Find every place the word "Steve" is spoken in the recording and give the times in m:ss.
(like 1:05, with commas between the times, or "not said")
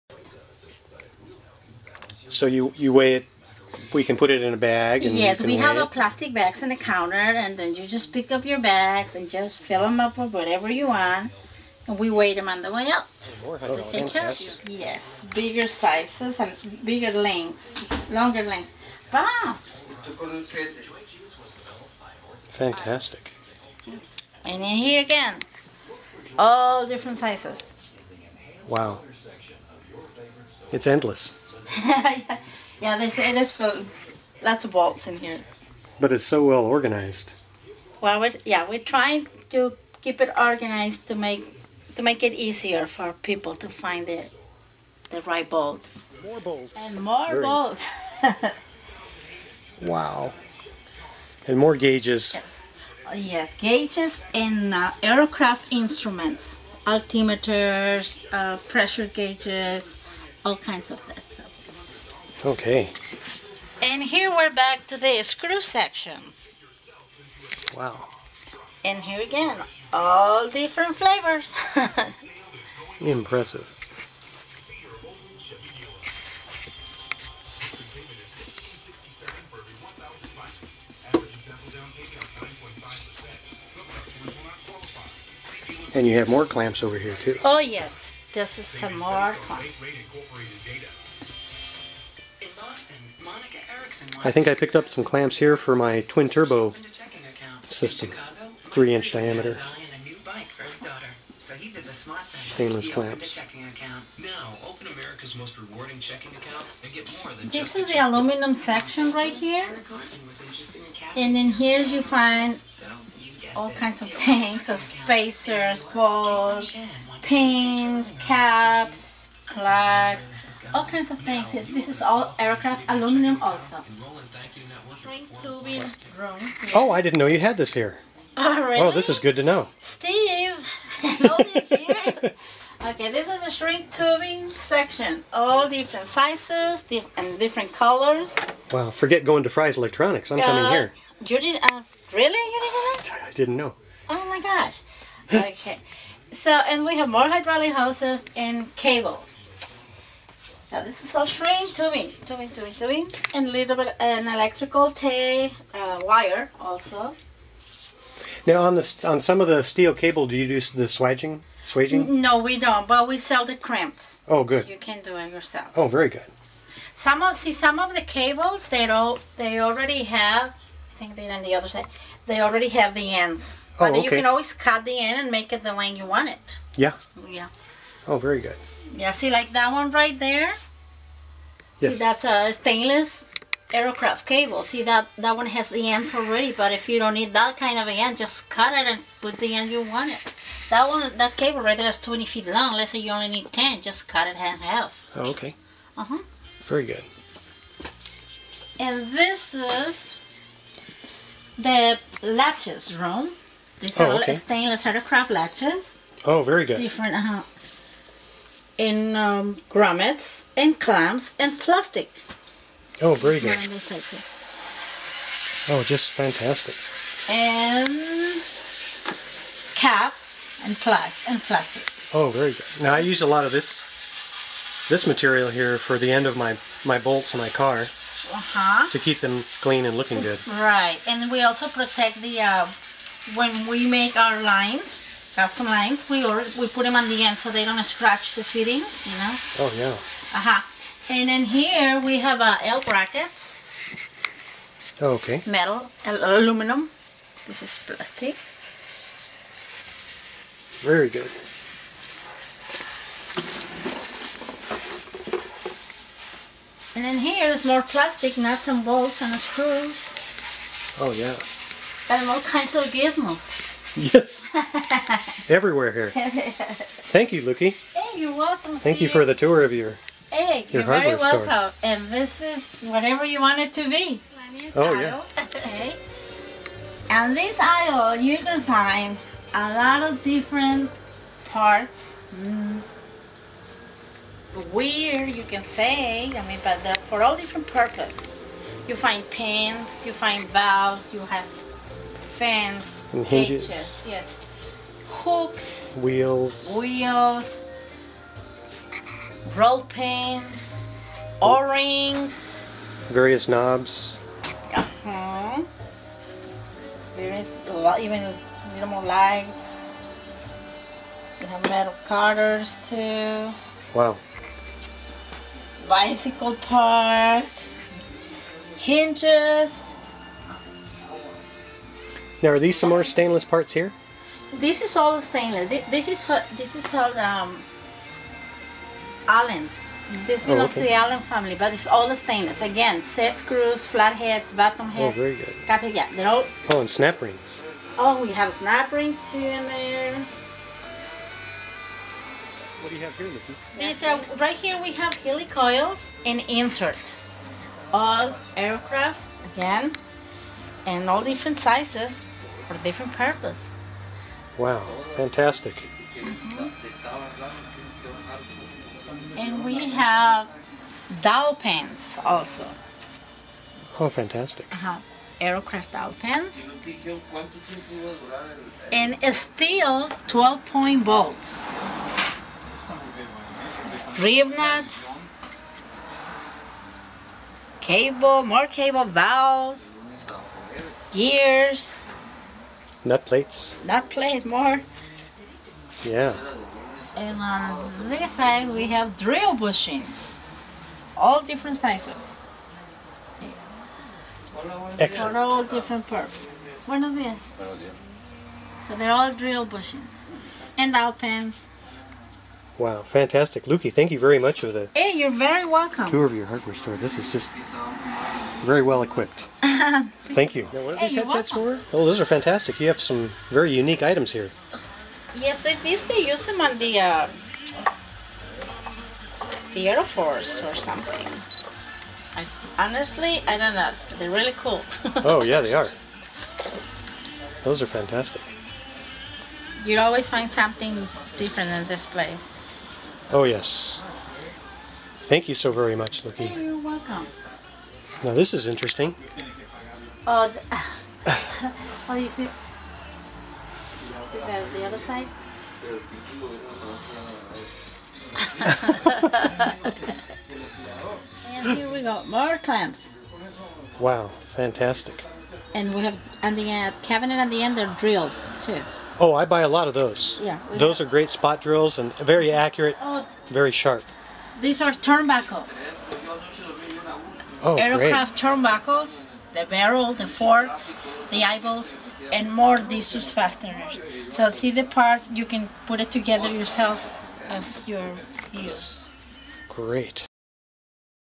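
2:09, 4:28.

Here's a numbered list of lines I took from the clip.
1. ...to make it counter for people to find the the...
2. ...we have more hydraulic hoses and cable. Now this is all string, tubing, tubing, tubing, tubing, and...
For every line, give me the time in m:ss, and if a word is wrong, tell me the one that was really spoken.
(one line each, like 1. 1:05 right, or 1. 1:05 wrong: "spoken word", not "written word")
1. 0:41 wrong: "easier", not "counter"
2. 2:26 right.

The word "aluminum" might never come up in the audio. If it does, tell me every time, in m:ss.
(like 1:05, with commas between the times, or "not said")
1:47, 2:02, 4:06.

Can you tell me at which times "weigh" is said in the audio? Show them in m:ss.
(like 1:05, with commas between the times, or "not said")
0:02, 0:12.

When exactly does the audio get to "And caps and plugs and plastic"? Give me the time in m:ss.
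3:37.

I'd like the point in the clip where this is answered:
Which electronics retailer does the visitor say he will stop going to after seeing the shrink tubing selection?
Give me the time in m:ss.
2:19.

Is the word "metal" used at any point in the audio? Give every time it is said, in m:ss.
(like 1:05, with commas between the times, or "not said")
4:05, 5:11.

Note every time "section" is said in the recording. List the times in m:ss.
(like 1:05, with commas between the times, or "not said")
1:05, 1:48, 2:14.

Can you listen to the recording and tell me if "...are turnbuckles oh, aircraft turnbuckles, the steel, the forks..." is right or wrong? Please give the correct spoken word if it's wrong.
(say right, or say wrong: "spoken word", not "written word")
wrong: "barrel", not "steel".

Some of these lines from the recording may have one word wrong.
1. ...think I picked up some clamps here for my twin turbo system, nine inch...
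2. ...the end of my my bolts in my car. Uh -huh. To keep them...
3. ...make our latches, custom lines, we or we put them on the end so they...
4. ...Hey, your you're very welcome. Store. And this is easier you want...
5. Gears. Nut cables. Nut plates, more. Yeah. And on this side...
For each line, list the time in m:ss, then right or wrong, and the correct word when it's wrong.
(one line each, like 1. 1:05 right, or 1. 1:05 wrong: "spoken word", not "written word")
1. 1:34 wrong: "three", not "nine"
2. 3:45 right
3. 3:53 wrong: "lines", not "latches"
4. 4:30 wrong: "whatever", not "easier"
5. 6:21 wrong: "plates", not "cables".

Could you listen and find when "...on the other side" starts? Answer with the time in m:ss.
2:51.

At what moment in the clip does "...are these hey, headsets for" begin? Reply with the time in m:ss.
6:50.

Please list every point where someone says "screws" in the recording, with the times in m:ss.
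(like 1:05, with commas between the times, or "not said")
1:05, 4:19, 5:33.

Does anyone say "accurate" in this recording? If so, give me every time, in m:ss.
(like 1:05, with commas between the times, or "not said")
7:42.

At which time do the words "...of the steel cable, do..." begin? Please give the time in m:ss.
2:39.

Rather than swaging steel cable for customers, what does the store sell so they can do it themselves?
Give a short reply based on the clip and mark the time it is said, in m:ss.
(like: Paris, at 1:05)
crimps, at 2:43.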